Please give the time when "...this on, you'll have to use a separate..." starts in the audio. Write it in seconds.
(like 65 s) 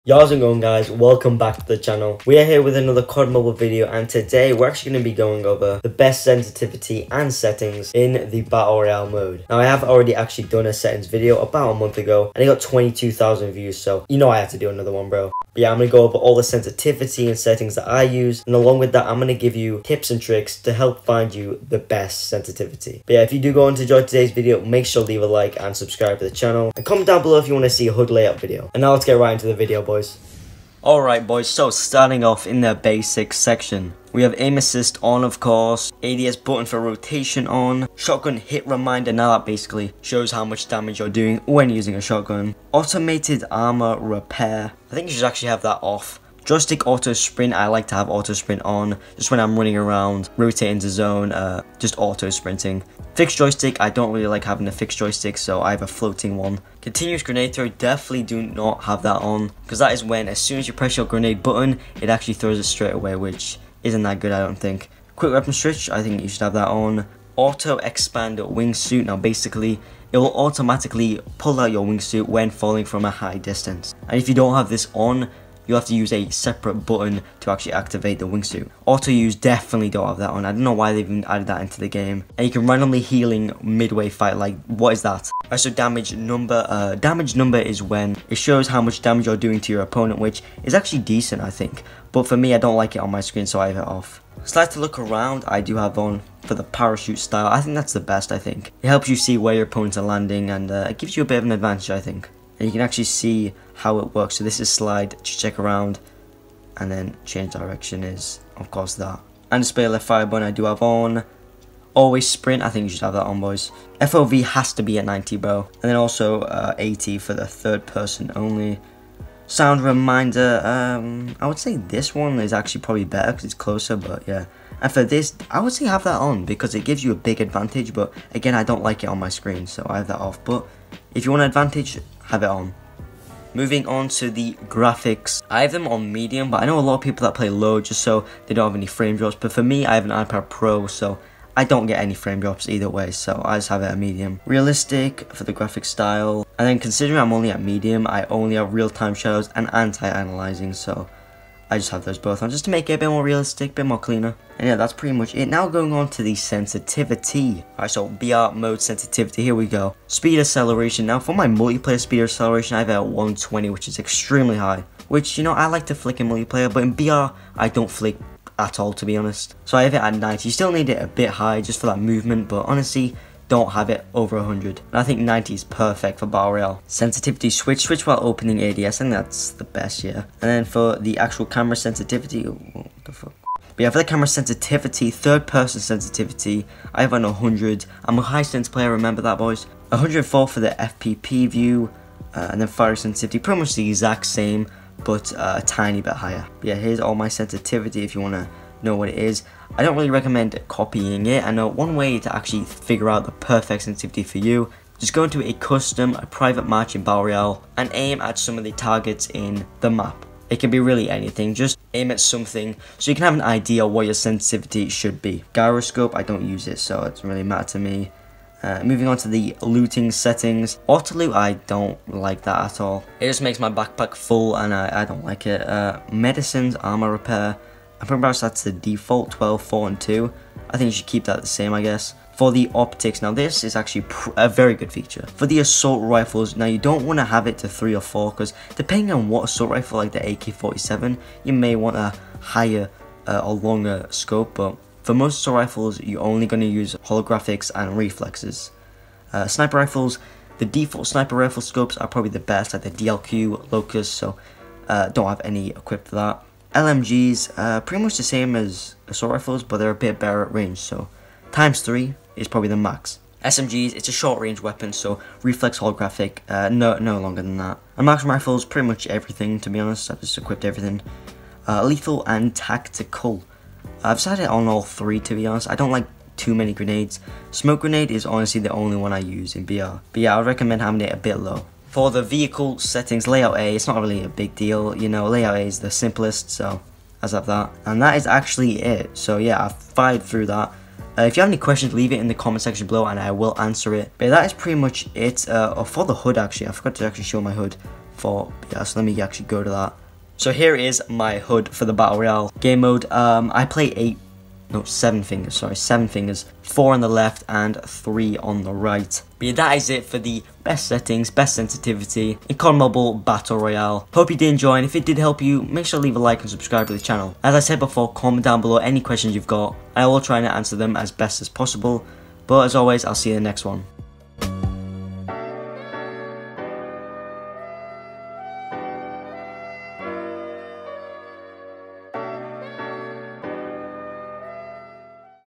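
74 s.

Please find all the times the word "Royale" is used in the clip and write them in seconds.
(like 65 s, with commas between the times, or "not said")
8 s, 207 s, 302 s, 313 s.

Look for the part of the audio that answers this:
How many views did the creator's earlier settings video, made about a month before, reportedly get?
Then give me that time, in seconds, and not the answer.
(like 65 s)
12 s.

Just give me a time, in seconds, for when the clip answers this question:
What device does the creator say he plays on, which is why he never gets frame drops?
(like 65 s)
140 s.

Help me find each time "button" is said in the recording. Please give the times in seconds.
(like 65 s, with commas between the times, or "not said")
36 s, 61 s, 76 s, 110 s.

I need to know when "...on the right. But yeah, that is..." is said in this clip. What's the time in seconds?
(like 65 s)
308 s.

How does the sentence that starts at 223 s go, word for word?
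It just makes my backpack full and I, I don't like it.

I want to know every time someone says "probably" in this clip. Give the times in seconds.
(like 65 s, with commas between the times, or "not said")
122 s, 252 s, 262 s.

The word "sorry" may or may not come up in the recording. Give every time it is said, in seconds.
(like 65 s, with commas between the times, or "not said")
305 s.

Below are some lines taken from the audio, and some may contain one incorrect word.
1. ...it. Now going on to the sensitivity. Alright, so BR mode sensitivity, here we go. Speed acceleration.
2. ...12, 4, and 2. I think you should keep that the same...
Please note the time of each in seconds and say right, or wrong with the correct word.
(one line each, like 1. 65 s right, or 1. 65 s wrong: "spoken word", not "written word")
1. 155 s right
2. 229 s right.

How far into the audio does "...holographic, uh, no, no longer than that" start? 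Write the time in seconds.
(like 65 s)
265 s.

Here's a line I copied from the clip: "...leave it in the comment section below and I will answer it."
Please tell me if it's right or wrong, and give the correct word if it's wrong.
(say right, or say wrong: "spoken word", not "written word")
right.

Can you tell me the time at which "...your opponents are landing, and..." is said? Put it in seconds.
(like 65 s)
99 s.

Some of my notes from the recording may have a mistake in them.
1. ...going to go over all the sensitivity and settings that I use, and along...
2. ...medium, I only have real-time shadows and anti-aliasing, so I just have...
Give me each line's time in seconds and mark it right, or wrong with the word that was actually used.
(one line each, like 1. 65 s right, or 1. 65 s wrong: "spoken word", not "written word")
1. 15 s right
2. 147 s right.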